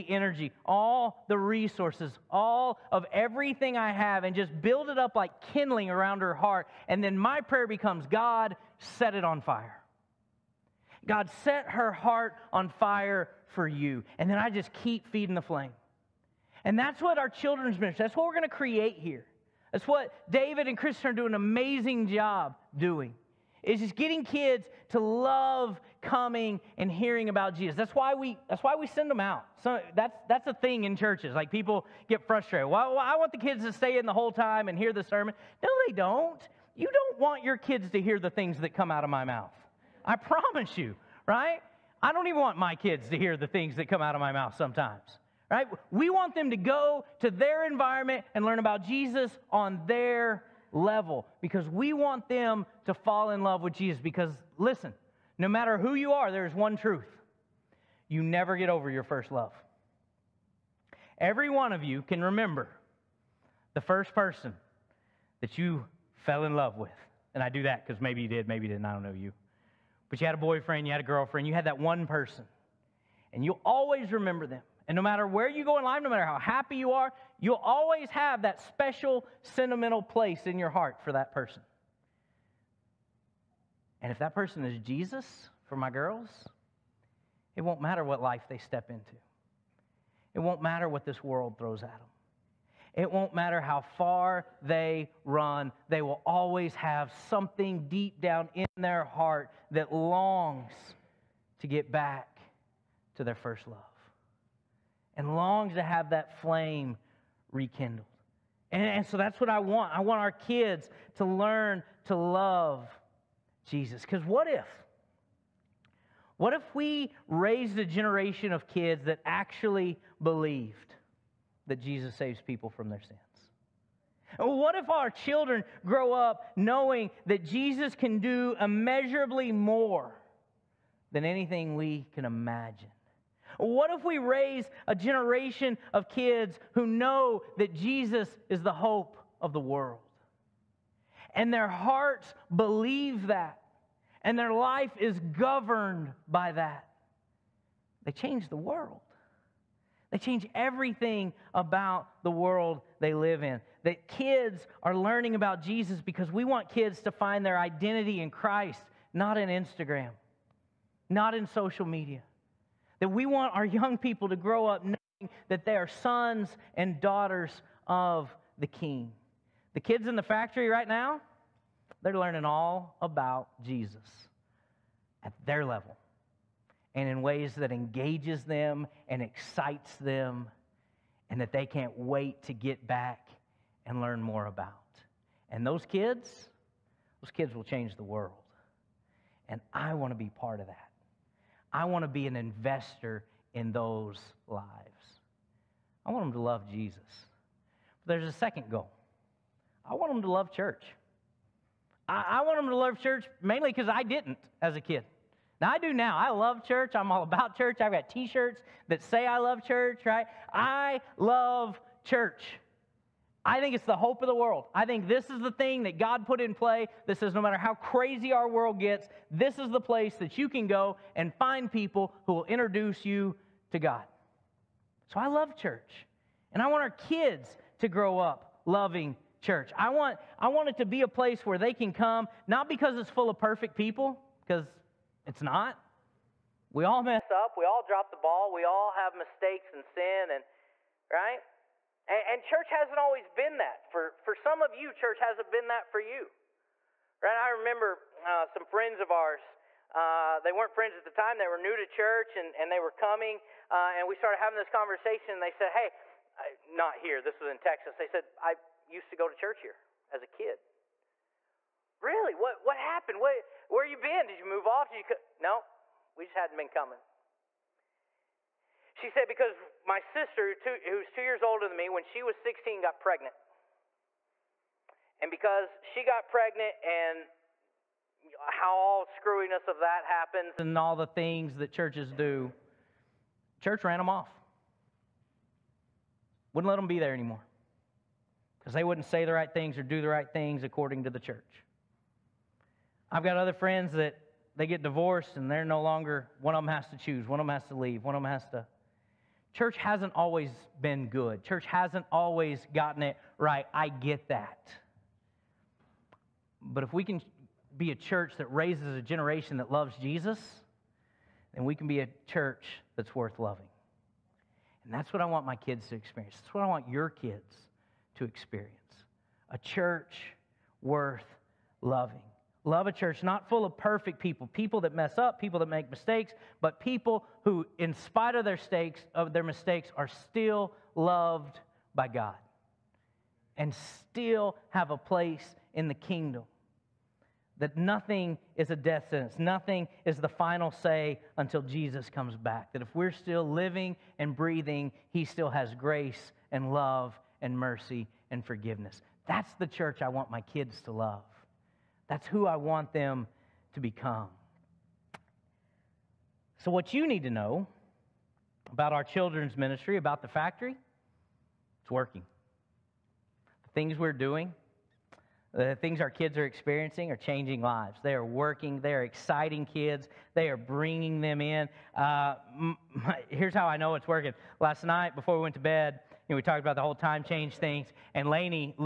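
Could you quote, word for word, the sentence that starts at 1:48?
And, and so that's what I want.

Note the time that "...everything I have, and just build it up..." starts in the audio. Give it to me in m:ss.
0:03.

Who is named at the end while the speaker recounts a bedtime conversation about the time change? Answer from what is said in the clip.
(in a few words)
Lainey.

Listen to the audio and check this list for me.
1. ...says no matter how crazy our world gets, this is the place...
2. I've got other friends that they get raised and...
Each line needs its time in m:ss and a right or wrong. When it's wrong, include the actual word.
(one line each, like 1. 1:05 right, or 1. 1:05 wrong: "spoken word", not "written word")
1. 3:37 right
2. 4:53 wrong: "divorced", not "raised".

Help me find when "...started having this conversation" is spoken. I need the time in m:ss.
4:14.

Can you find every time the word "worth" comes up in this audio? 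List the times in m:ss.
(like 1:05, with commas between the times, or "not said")
5:13, 5:20.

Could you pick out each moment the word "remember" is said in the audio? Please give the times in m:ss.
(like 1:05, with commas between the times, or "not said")
1:02, 1:14, 4:07.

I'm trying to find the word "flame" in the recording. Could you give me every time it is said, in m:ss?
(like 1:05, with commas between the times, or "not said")
0:15, 1:46.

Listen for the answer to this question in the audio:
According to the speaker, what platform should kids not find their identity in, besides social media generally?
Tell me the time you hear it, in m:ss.
2:39.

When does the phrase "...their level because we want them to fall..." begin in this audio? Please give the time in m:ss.
0:49.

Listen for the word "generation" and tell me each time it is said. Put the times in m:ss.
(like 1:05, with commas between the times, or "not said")
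1:57, 2:14, 5:09.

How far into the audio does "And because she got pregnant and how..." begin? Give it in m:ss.
4:35.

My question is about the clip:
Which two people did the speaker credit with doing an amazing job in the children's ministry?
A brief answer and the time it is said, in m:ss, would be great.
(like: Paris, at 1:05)
David and Christian, at 0:20.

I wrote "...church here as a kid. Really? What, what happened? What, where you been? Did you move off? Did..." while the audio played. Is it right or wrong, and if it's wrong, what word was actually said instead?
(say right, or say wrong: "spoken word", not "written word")
right.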